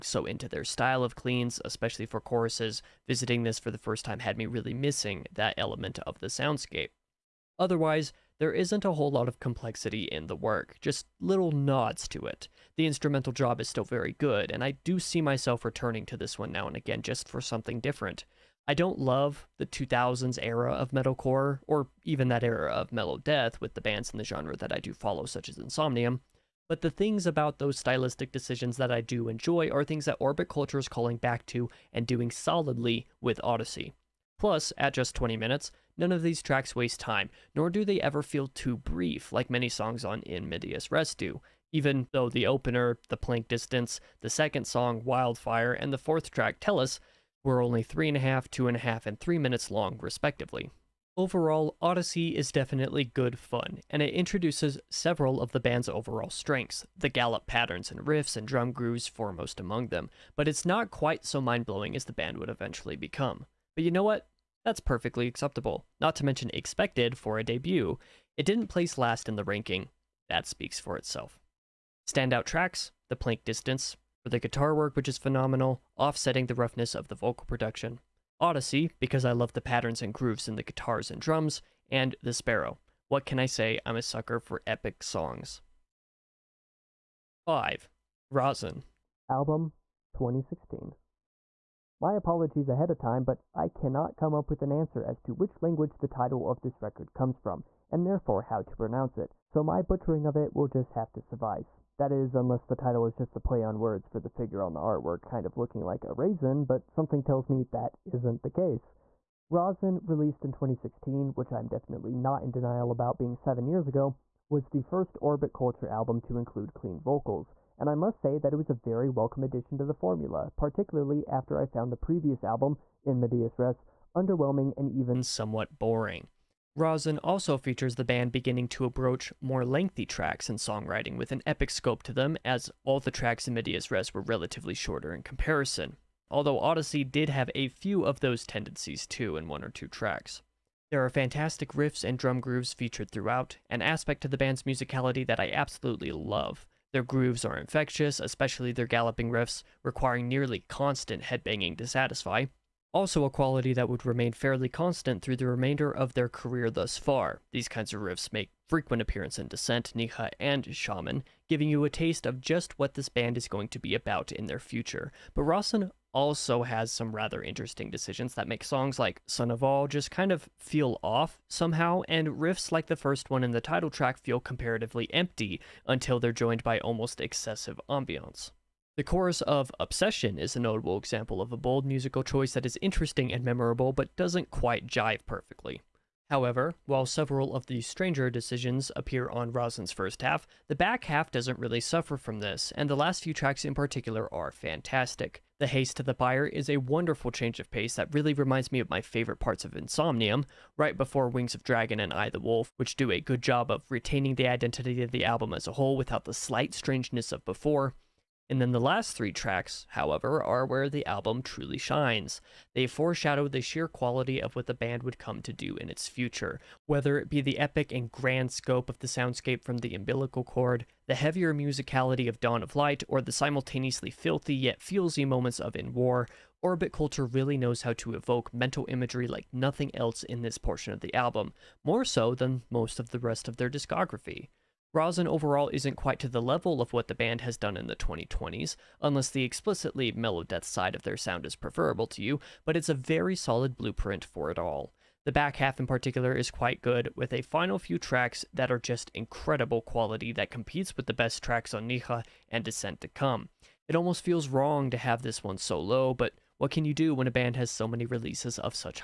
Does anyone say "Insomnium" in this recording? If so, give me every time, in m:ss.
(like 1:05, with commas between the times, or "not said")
0:25, 3:19.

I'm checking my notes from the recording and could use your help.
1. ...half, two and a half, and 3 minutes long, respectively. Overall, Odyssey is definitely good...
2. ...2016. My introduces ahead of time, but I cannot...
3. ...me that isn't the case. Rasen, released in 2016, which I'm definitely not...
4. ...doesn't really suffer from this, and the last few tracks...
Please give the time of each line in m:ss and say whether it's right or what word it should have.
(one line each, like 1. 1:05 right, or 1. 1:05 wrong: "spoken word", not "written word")
1. 0:48 right
2. 1:30 wrong: "apologies", not "introduces"
3. 1:47 right
4. 3:11 right.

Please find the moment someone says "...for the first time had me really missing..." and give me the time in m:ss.
0:03.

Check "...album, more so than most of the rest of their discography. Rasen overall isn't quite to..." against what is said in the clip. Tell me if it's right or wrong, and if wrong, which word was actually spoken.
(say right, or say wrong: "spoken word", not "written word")
right.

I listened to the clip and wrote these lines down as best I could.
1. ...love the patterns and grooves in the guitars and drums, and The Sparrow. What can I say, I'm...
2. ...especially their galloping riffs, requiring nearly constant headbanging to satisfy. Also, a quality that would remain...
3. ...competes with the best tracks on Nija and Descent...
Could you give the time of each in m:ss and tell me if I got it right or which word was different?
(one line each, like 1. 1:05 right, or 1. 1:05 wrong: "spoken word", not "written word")
1. 1:19 right
2. 2:28 right
3. 4:10 right.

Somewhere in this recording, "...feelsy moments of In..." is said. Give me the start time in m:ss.
3:44.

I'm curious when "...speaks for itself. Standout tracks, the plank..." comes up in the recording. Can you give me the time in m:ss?
1:10.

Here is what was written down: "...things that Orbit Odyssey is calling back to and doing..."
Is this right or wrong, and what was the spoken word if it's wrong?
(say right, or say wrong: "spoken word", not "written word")
wrong: "Culture", not "Odyssey".